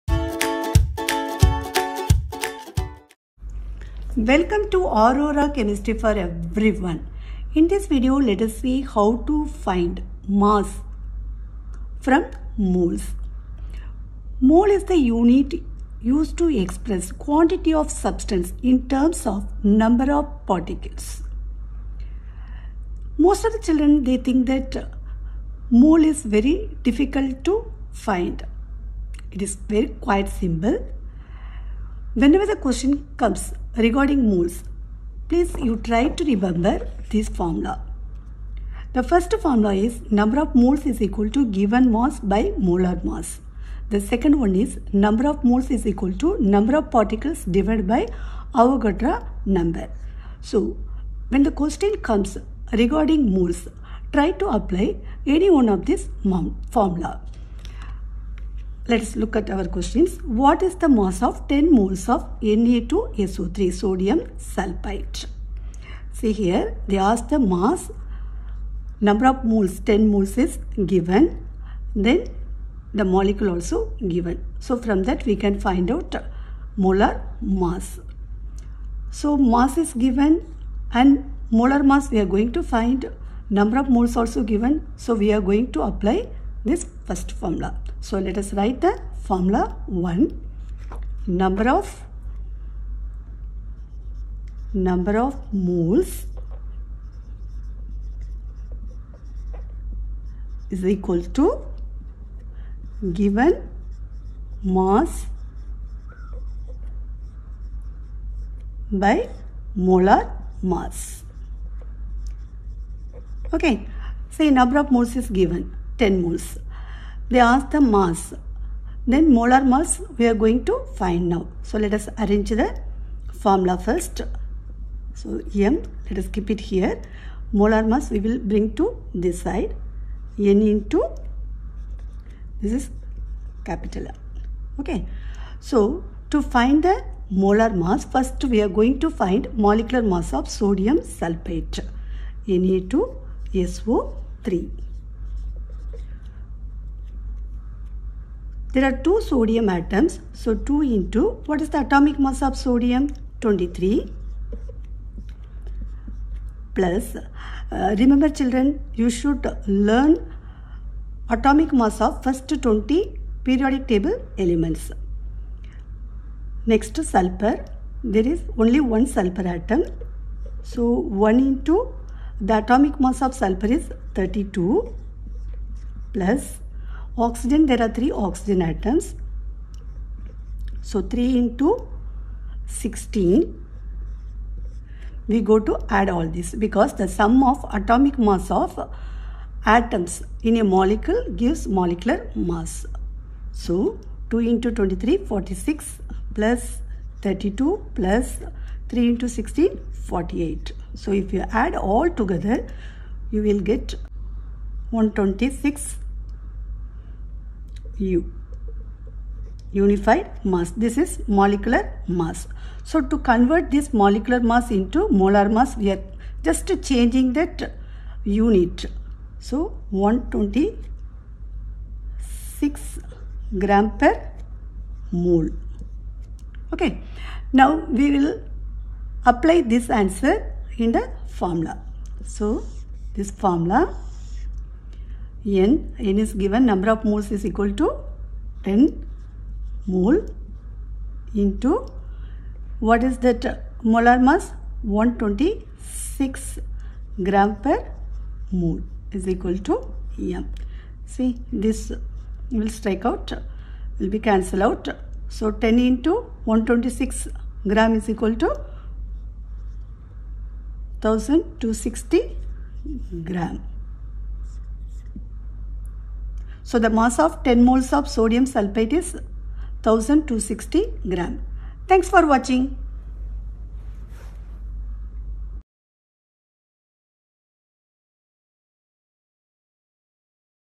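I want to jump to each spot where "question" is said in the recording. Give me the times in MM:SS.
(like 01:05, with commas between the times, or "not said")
00:32, 00:51, 00:59.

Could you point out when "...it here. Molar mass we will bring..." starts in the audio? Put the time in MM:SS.
02:06.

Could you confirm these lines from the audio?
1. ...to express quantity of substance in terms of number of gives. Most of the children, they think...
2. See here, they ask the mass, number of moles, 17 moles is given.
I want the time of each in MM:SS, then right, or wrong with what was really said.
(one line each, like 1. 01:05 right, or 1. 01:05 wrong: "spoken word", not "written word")
1. 00:16 wrong: "particles", not "gives"
2. 01:06 wrong: "10", not "17".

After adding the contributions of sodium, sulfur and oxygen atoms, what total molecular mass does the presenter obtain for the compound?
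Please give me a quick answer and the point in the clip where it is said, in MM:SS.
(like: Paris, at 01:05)
126 u, at 03:24.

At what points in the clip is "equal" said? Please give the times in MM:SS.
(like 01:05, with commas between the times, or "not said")
00:41, 00:45, 01:40, 03:57, 04:09, 04:18.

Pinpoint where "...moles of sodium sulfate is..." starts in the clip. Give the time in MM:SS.
04:27.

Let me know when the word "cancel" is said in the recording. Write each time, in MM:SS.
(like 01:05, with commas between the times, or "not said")
04:14.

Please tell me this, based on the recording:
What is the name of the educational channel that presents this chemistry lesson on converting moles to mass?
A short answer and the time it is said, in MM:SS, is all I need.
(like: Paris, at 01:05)
Aurora Chemistry, at 00:04.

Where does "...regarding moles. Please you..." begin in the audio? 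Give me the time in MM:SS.
00:33.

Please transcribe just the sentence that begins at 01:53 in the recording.
Okay, say number of moles is given.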